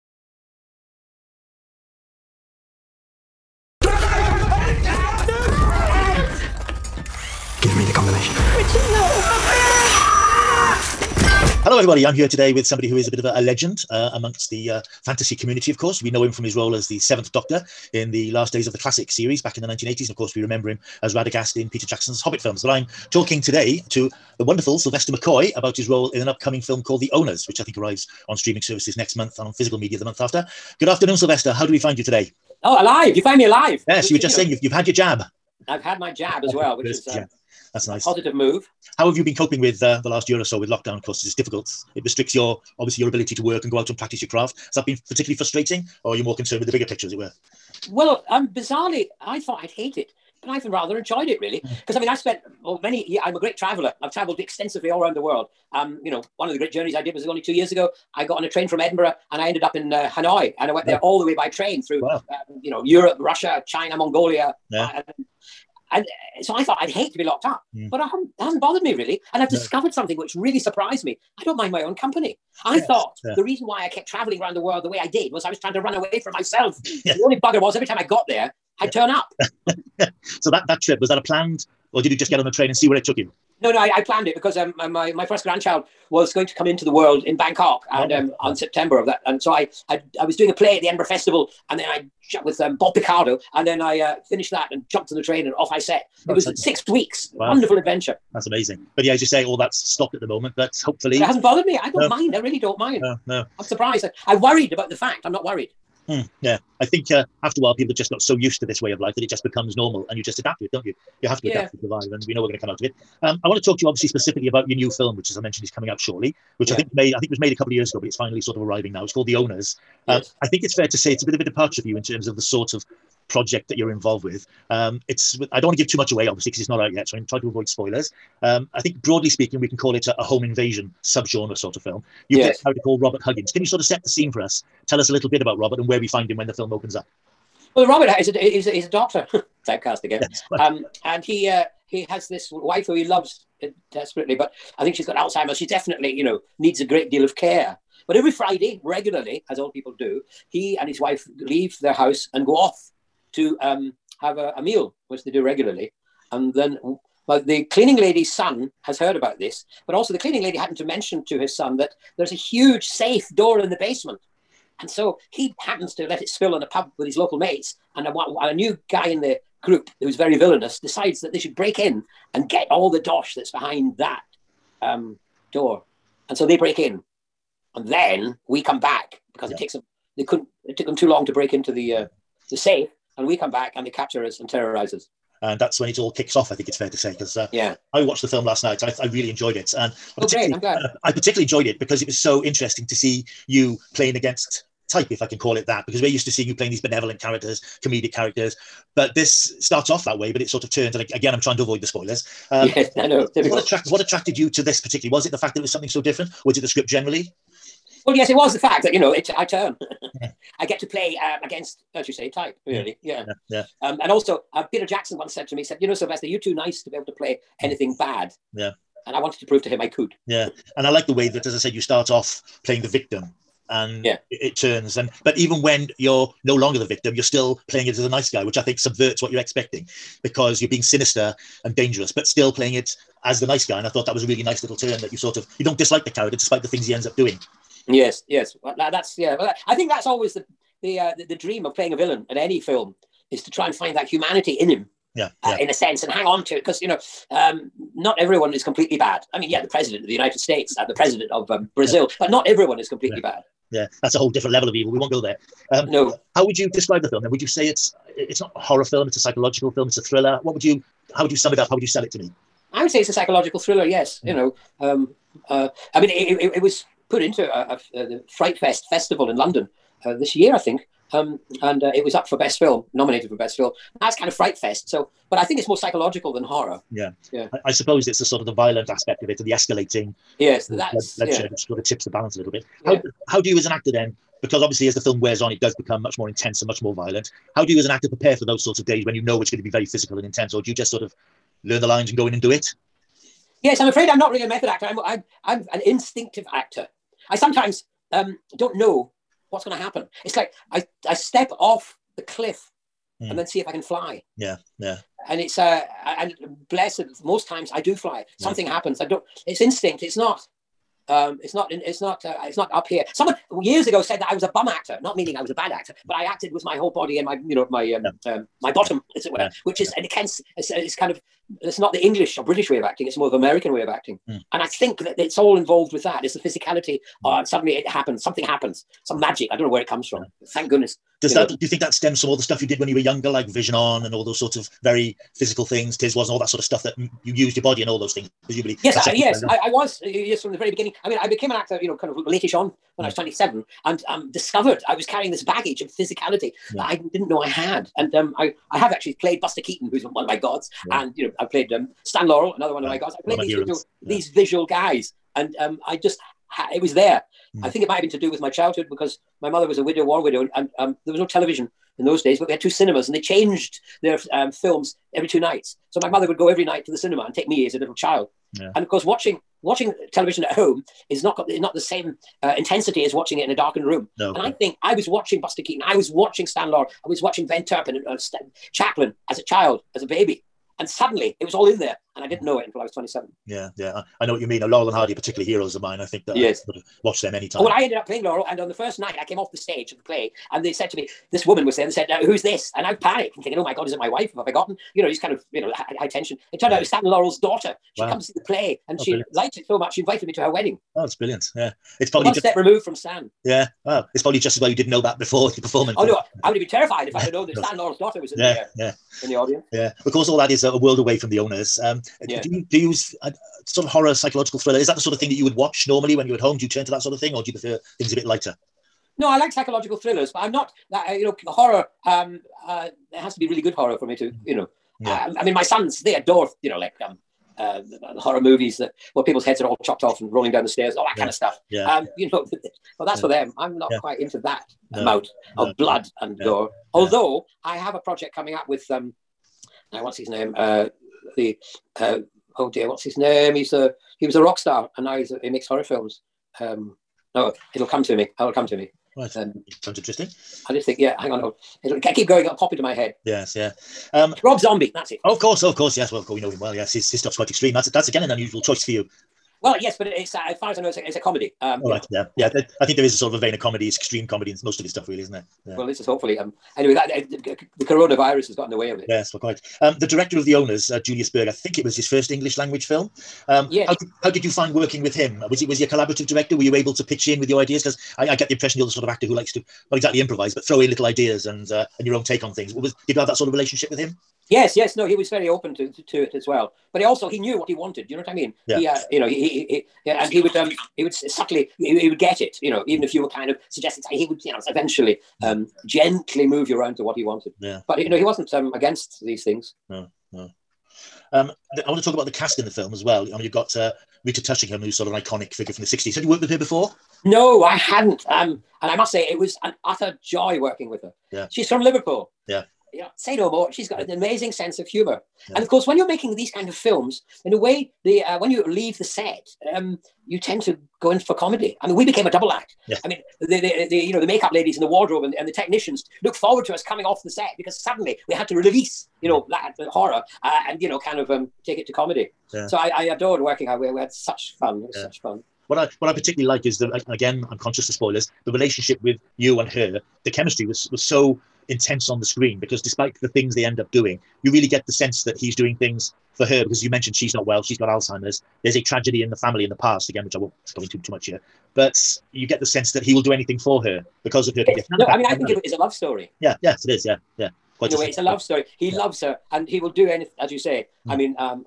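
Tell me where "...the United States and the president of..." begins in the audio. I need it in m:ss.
4:10.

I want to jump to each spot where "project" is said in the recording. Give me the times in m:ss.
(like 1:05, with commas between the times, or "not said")
2:03, 7:17.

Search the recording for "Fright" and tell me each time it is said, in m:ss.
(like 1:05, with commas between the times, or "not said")
4:28, 4:34.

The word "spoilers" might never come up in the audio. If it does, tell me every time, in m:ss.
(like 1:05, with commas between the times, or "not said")
2:07, 3:21, 8:57.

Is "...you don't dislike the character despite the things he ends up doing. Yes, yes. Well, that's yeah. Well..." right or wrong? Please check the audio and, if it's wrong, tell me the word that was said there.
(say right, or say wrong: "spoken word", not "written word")
right.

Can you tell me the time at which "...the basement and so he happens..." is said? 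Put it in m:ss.
2:43.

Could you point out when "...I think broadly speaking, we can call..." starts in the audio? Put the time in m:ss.
2:08.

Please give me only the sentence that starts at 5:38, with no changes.
Presumably, yes, I, yes, I, I, was yes from the very beginning.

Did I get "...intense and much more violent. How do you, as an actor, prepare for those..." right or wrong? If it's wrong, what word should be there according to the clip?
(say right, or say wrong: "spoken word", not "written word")
right.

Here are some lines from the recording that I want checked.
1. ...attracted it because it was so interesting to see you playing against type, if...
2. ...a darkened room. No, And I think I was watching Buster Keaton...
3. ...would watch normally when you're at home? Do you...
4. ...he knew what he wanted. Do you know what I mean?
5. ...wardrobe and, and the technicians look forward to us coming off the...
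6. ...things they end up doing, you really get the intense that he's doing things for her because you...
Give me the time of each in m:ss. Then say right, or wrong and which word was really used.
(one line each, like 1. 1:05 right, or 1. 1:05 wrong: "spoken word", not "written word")
1. 3:11 wrong: "enjoyed", not "attracted"
2. 6:13 right
3. 6:55 right
4. 8:07 right
5. 8:44 right
6. 9:03 wrong: "sense", not "intense".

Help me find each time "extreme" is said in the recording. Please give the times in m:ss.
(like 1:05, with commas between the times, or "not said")
7:37, 7:43.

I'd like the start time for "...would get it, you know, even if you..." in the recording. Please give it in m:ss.
8:12.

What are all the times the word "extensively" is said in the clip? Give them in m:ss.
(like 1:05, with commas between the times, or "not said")
0:54.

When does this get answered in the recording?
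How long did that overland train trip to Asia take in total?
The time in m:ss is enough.
1:36.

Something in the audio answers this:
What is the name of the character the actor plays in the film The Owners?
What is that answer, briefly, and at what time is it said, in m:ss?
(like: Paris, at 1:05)
Robert Huggins, at 2:12.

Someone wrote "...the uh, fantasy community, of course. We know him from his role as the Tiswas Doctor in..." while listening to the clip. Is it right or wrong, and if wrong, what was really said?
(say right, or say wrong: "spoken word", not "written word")
wrong: "Seventh", not "Tiswas".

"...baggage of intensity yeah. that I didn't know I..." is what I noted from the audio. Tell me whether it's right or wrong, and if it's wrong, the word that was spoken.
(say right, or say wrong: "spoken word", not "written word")
wrong: "physicality", not "intensity".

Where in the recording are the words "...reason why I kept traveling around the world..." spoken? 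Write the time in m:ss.
1:13.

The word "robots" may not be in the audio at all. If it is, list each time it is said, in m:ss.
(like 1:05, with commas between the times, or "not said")
not said.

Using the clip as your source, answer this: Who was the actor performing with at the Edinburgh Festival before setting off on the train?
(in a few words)
Bob Picardo.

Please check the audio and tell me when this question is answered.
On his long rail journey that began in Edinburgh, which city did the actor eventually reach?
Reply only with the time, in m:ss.
1:00.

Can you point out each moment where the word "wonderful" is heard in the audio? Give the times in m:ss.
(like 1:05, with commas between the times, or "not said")
0:24, 1:37.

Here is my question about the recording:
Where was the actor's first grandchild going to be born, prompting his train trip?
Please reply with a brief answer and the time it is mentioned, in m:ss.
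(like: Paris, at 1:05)
Bangkok, at 1:27.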